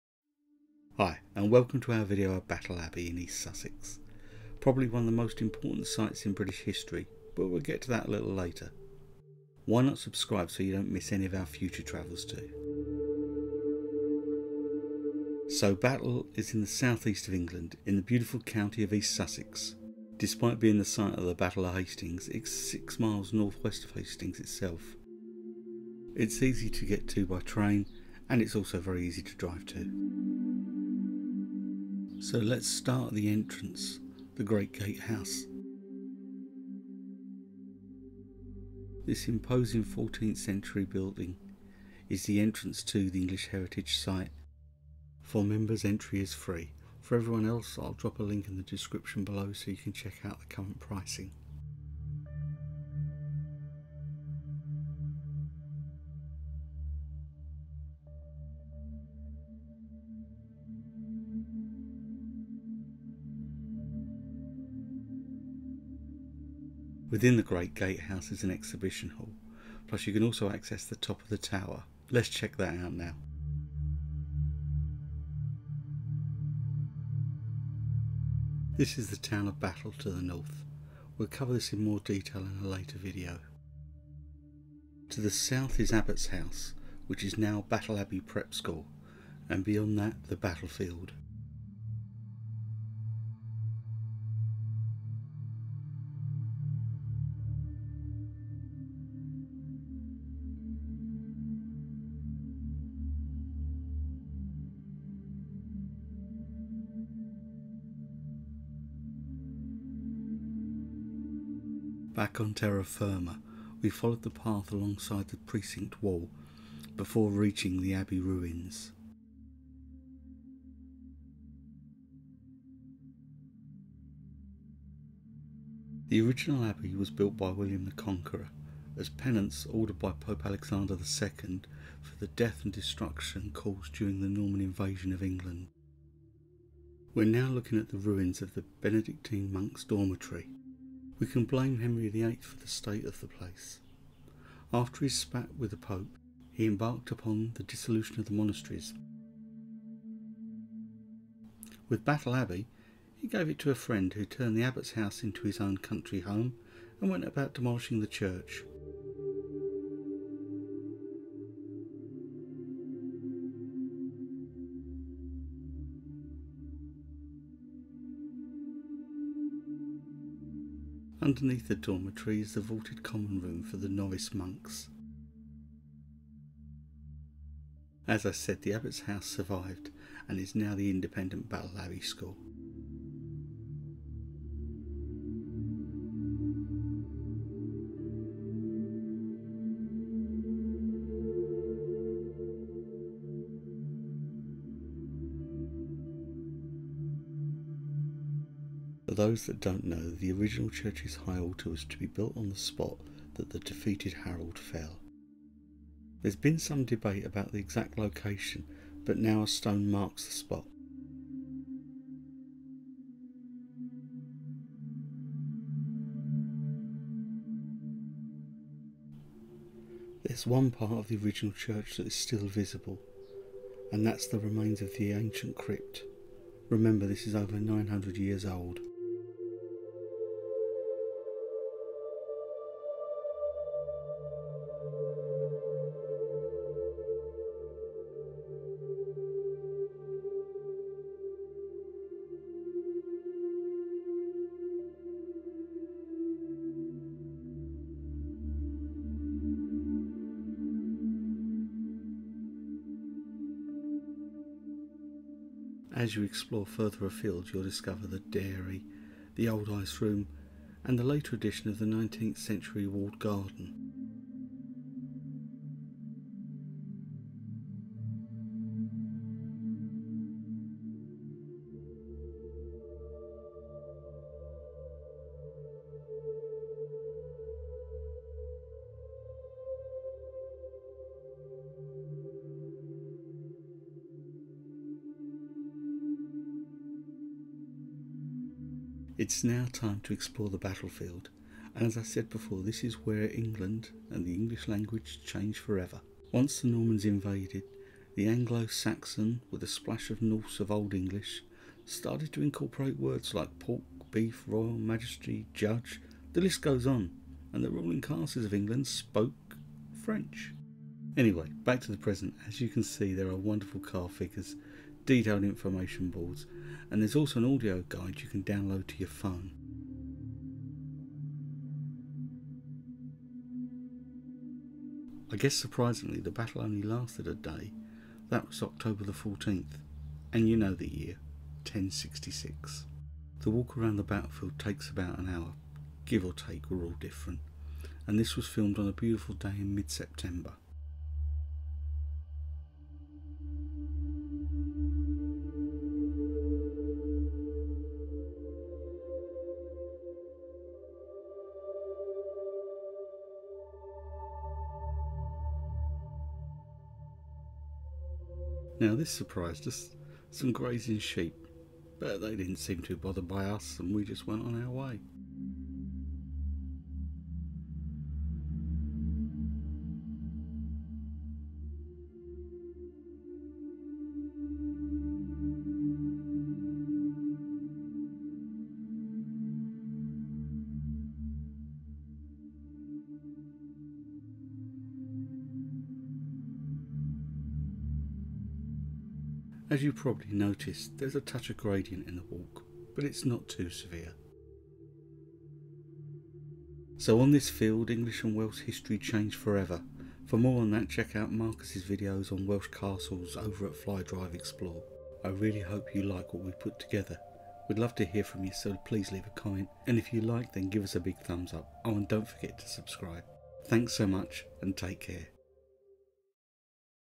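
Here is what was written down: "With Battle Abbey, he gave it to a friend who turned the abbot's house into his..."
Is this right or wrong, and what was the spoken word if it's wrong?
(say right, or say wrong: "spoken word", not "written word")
right.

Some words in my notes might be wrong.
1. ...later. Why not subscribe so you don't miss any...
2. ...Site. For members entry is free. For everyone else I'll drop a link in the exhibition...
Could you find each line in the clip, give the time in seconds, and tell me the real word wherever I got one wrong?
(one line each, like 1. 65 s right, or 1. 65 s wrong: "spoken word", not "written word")
1. 8 s right
2. 43 s wrong: "description", not "exhibition".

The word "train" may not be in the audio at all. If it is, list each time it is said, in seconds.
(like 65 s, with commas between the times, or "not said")
27 s.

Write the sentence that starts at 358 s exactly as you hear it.
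Now this surprised us, some grazing sheep, but they didn't seem too bothered by us and we just went on our way.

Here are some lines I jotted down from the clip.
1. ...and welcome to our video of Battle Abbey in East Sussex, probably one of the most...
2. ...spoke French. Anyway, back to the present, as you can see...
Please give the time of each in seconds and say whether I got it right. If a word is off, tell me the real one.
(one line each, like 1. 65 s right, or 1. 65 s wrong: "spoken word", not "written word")
1. 1 s right
2. 308 s right.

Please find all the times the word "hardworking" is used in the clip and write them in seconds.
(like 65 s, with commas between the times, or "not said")
not said.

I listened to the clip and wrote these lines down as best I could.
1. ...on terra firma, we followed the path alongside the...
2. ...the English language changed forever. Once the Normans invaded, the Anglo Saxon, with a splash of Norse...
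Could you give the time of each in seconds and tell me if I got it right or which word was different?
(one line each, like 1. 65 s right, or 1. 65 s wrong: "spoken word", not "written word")
1. 112 s right
2. 294 s right.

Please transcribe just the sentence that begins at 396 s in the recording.
So on this field, English and Welsh history changed forever.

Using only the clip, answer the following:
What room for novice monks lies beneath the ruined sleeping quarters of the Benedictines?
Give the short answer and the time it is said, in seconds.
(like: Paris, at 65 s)
vaulted common room, at 172 s.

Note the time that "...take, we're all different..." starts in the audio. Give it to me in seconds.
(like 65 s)
336 s.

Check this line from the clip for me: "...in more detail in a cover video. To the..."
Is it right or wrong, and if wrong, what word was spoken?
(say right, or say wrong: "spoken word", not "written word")
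wrong: "later", not "cover".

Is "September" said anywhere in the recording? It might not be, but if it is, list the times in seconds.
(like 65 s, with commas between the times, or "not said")
339 s.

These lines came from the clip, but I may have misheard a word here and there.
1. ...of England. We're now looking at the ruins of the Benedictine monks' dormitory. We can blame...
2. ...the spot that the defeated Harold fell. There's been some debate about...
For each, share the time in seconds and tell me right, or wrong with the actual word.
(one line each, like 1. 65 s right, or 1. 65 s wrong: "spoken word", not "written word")
1. 135 s right
2. 202 s right.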